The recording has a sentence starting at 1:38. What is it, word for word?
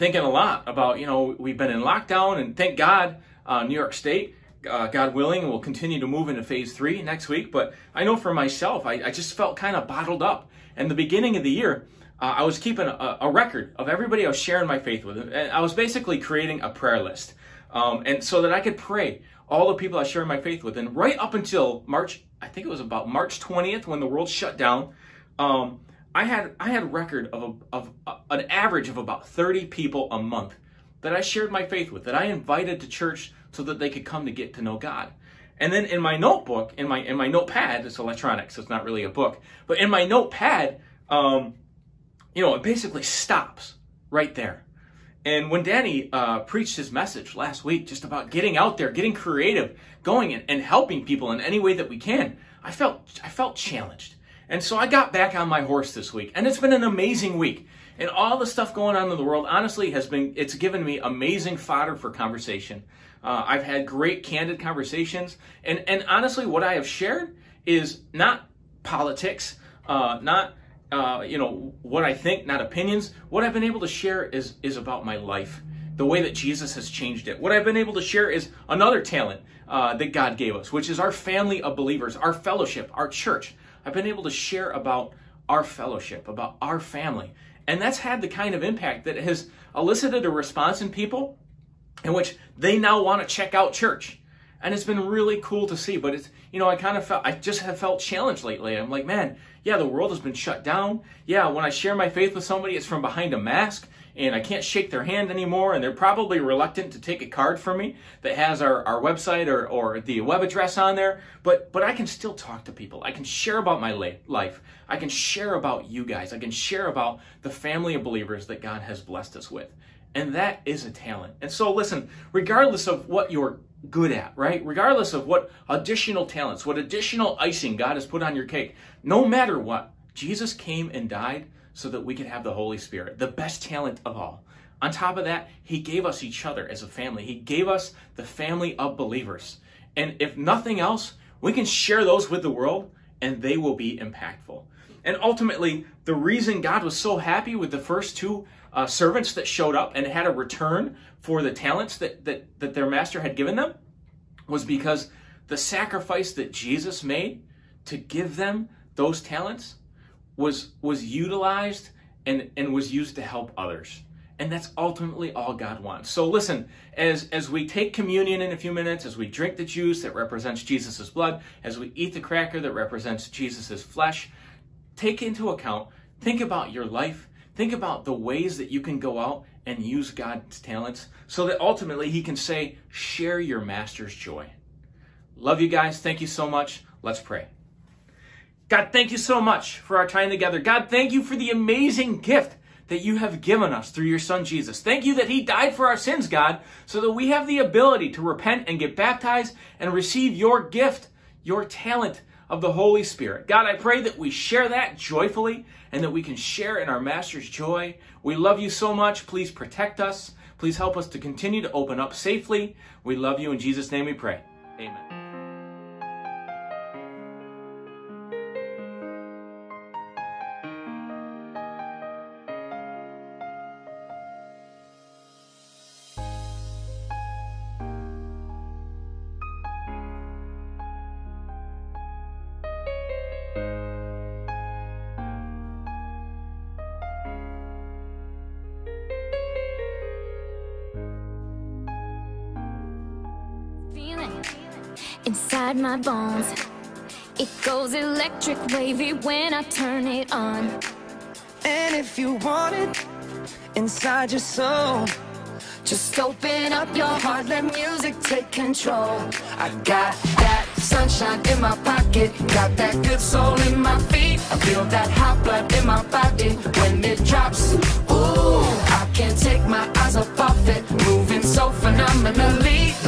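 I'm like, man, yeah, the world has been shut down.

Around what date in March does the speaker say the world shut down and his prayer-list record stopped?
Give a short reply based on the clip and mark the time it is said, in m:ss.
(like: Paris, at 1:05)
March 20th, at 0:23.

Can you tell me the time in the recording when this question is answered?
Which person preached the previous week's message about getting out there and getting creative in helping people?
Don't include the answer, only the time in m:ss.
0:45.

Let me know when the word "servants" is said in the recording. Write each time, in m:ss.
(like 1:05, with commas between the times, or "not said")
2:28.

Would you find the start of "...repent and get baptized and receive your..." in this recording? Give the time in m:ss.
3:18.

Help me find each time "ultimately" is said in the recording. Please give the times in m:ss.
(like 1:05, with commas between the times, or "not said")
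2:25, 2:44, 3:01.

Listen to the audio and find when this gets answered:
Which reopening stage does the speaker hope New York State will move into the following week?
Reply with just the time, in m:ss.
0:06.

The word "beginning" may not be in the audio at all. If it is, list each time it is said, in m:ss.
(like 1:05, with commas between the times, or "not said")
0:10.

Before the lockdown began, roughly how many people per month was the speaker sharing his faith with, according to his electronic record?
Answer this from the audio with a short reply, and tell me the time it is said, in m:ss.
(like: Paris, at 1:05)
30, at 0:29.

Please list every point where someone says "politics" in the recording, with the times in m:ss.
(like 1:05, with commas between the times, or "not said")
1:08.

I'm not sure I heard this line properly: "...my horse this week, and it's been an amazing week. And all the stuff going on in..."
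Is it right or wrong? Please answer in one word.
right.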